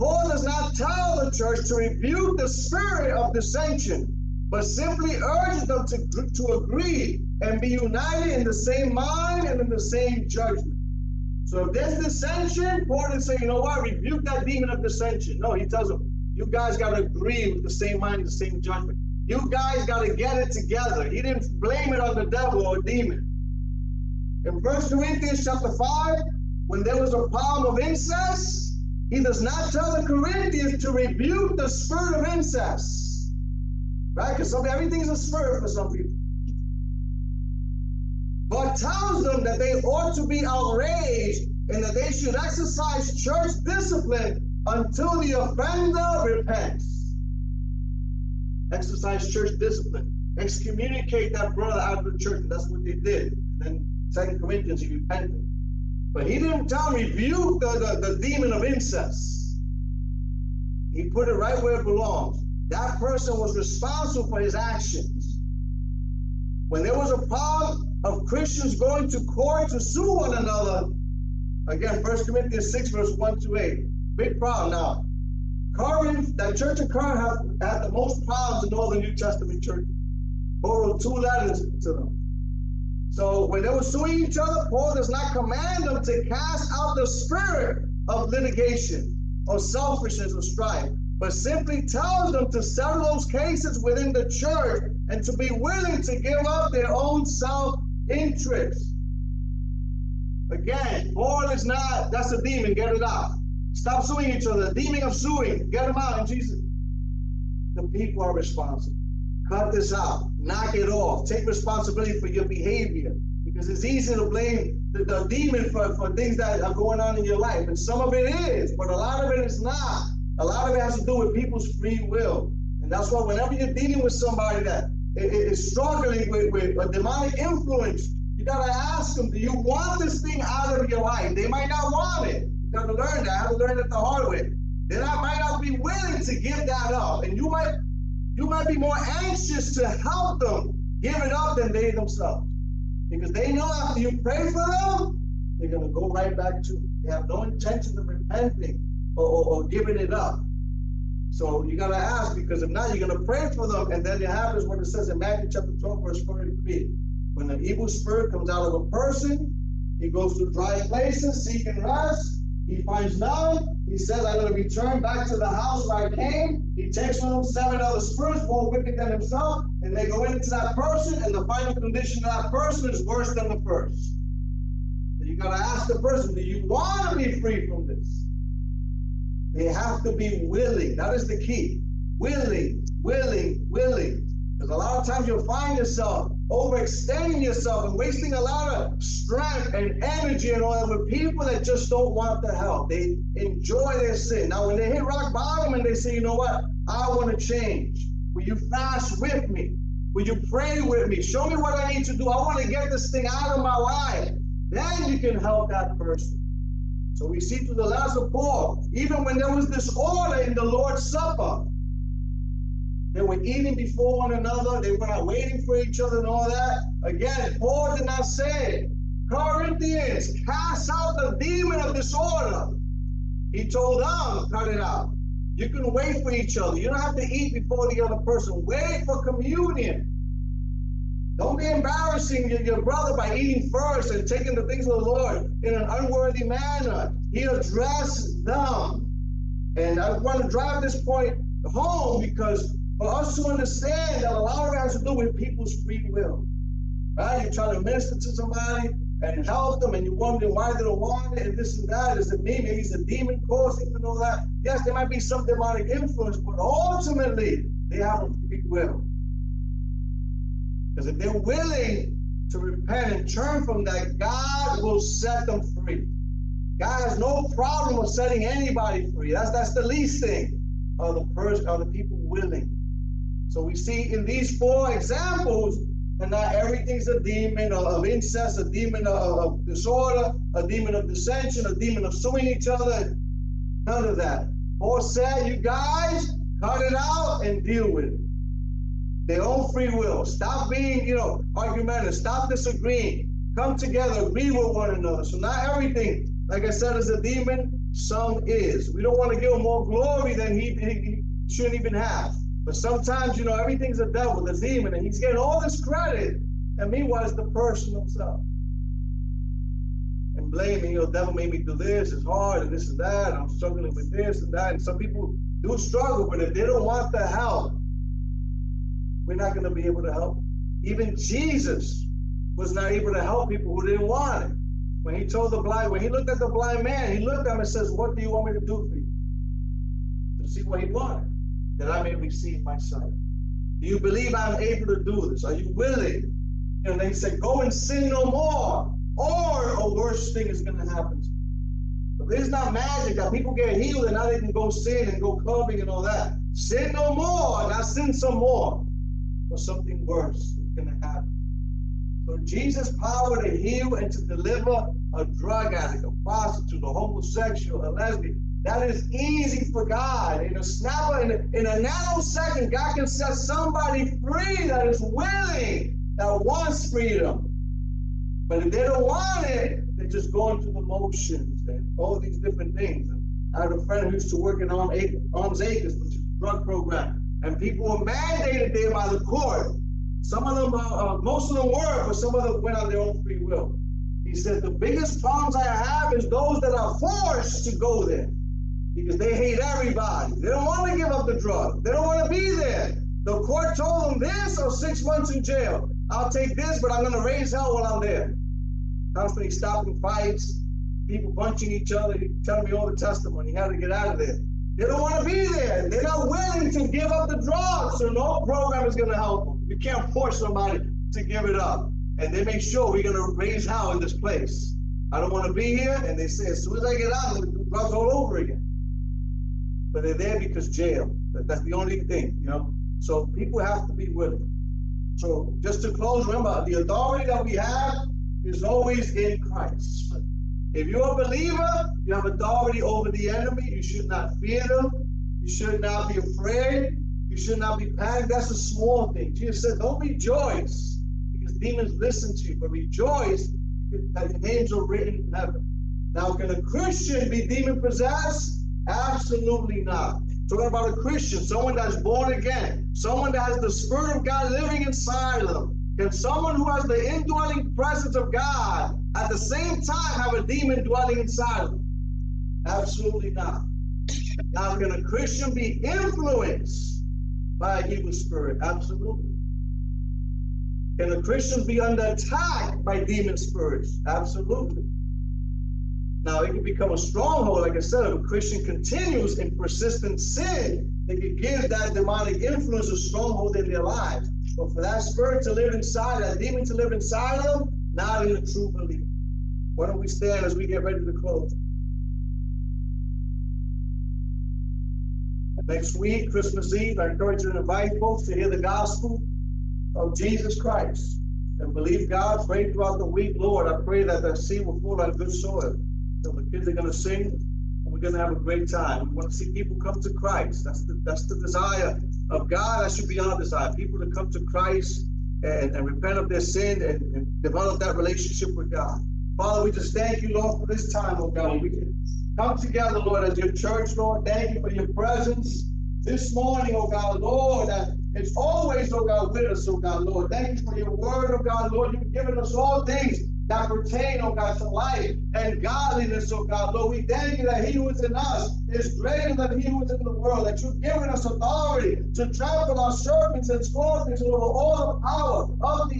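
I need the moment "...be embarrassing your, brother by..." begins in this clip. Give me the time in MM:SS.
03:51.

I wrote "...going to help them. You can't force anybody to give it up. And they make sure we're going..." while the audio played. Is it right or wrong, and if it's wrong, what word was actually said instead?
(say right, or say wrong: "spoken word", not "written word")
wrong: "somebody", not "anybody".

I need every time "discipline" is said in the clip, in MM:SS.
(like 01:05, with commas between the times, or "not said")
00:43, 00:49.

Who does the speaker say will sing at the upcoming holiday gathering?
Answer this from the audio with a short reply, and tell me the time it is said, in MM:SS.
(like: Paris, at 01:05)
The kids, at 08:26.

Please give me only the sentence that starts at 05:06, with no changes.
And meanwhile, it's the person himself.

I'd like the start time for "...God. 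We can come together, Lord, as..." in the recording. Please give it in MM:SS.
08:41.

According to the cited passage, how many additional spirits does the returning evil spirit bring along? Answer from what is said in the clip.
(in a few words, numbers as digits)
7.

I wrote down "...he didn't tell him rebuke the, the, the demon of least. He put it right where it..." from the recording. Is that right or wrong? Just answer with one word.
wrong.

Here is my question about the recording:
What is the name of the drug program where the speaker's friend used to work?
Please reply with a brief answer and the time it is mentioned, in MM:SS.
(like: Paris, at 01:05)
Arms Acres, at 06:14.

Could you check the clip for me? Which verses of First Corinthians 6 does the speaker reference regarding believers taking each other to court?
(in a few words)
1 to 8.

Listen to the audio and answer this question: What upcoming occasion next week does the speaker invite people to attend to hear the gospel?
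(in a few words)
Christmas Eve.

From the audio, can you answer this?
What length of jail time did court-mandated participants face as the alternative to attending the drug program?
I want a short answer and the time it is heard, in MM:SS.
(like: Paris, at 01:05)
6 months, at 06:34.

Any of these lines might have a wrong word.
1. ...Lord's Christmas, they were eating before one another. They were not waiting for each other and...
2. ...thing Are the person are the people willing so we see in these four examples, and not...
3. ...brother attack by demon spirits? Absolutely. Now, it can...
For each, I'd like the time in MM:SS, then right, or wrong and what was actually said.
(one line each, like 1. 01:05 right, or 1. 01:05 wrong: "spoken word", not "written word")
1. 03:30 wrong: "Supper", not "Christmas"
2. 04:30 right
3. 07:51 wrong: "under", not "brother".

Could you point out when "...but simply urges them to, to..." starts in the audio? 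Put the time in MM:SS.
00:04.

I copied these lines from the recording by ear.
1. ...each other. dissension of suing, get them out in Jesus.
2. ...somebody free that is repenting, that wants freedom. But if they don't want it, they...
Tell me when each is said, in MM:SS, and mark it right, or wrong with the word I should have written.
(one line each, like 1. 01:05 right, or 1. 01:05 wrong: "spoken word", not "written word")
1. 01:44 wrong: "demon", not "dissension"
2. 06:03 wrong: "willing", not "repenting".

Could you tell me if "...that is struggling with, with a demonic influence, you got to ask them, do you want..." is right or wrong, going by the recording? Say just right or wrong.
right.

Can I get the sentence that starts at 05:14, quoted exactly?
And some people do struggle, but if they don't want the help, we're not going to be able to help.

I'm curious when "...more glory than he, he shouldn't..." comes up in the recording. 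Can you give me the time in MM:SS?
04:59.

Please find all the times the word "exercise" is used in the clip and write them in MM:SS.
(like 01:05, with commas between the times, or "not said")
00:42, 00:48.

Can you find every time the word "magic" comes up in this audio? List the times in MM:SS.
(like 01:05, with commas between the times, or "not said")
05:42.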